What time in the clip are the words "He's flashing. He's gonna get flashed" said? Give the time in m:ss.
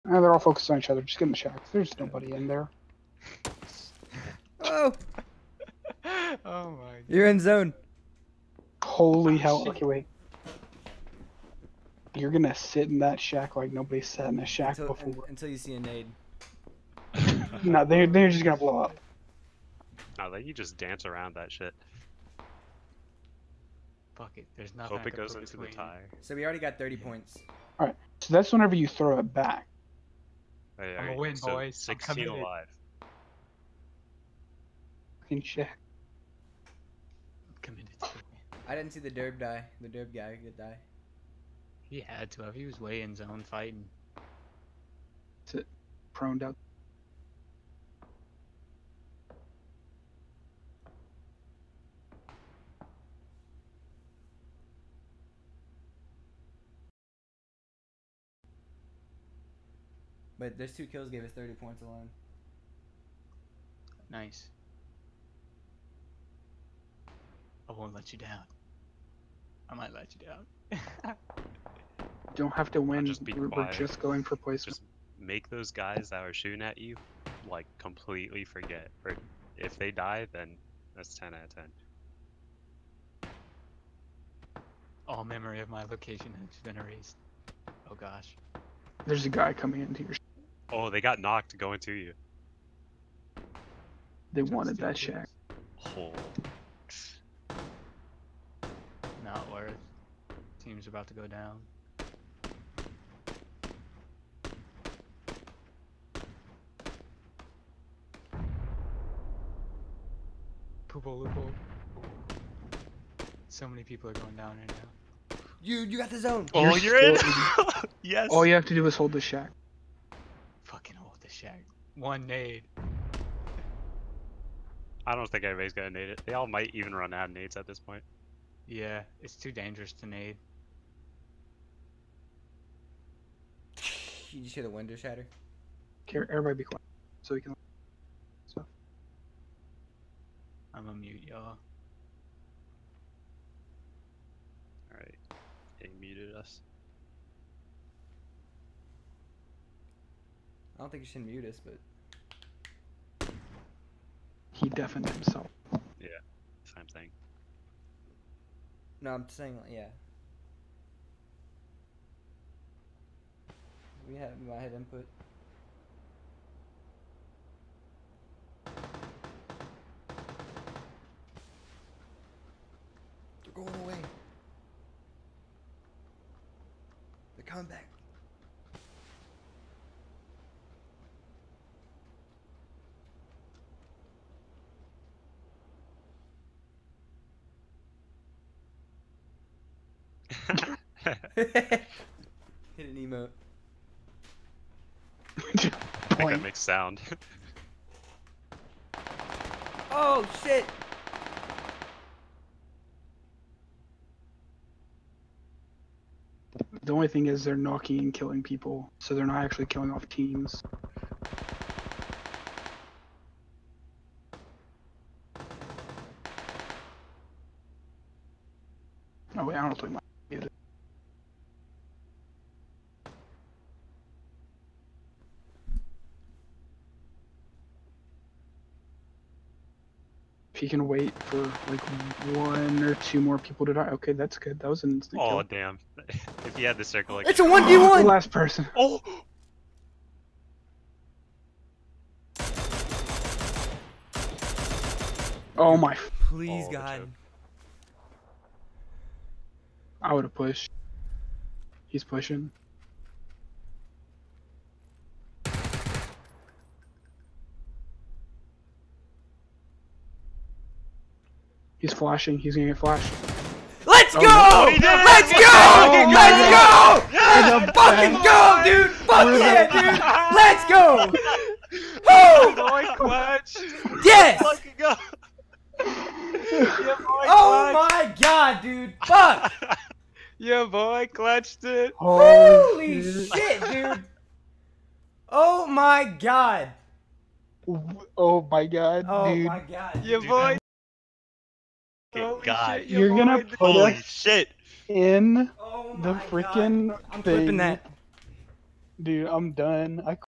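4:21.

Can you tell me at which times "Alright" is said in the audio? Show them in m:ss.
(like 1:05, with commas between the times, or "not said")
0:27.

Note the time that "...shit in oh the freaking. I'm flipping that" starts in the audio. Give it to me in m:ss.
4:54.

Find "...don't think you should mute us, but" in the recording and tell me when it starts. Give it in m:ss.
2:30.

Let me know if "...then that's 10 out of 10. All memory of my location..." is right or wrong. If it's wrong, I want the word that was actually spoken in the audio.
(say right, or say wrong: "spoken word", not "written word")
right.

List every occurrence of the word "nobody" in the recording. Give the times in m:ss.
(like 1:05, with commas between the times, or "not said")
0:01, 0:13.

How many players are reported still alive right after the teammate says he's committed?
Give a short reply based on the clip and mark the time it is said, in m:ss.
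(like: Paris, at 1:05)
16, at 0:31.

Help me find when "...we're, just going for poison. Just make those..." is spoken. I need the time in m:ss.
1:13.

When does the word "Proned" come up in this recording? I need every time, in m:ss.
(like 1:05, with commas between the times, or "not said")
0:46.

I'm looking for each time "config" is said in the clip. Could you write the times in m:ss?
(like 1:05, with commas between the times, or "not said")
not said.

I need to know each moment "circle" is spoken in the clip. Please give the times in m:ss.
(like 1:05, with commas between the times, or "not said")
3:56.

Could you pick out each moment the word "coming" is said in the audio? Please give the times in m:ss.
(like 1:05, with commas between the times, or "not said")
1:29, 2:57.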